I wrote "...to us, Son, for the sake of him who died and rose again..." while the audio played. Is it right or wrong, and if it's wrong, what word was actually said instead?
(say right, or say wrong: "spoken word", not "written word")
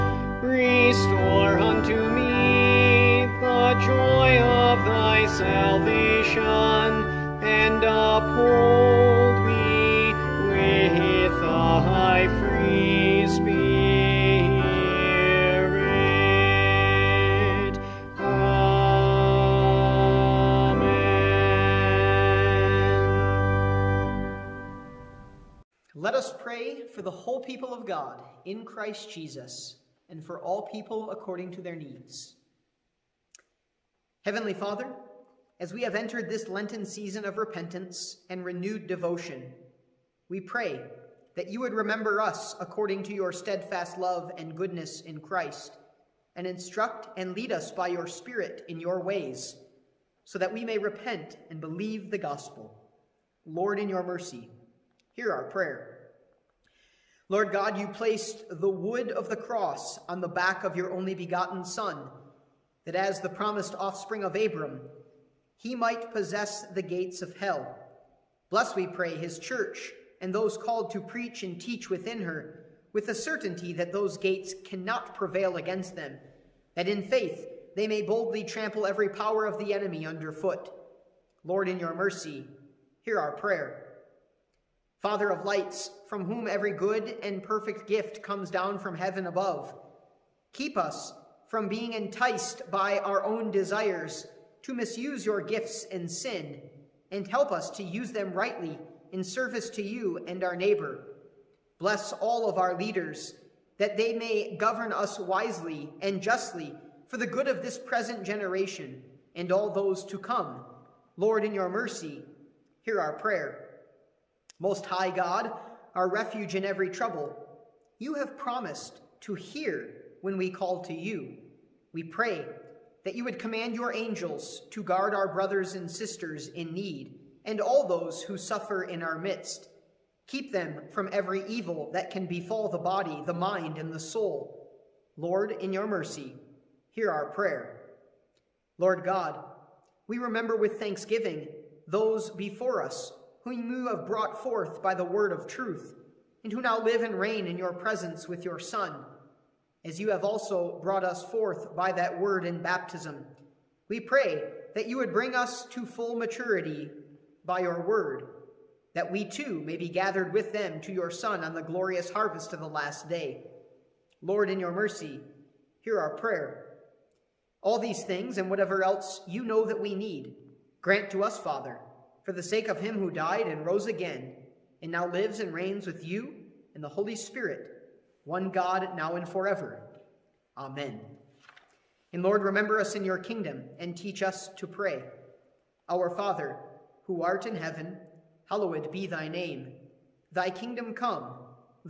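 wrong: "Father", not "Son".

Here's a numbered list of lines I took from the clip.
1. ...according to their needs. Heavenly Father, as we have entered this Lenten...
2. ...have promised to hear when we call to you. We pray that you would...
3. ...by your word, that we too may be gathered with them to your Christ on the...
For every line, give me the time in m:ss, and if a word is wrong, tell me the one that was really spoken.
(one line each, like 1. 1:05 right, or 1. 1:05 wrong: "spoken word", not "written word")
1. 0:31 right
2. 1:58 right
3. 2:37 wrong: "Son", not "Christ".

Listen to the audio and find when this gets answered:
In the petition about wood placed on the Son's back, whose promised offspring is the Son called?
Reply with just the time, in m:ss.
1:04.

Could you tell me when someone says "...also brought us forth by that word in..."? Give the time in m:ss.
2:30.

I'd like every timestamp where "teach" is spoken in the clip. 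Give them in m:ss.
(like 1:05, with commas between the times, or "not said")
1:11, 3:03.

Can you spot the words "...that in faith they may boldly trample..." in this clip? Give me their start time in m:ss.
1:16.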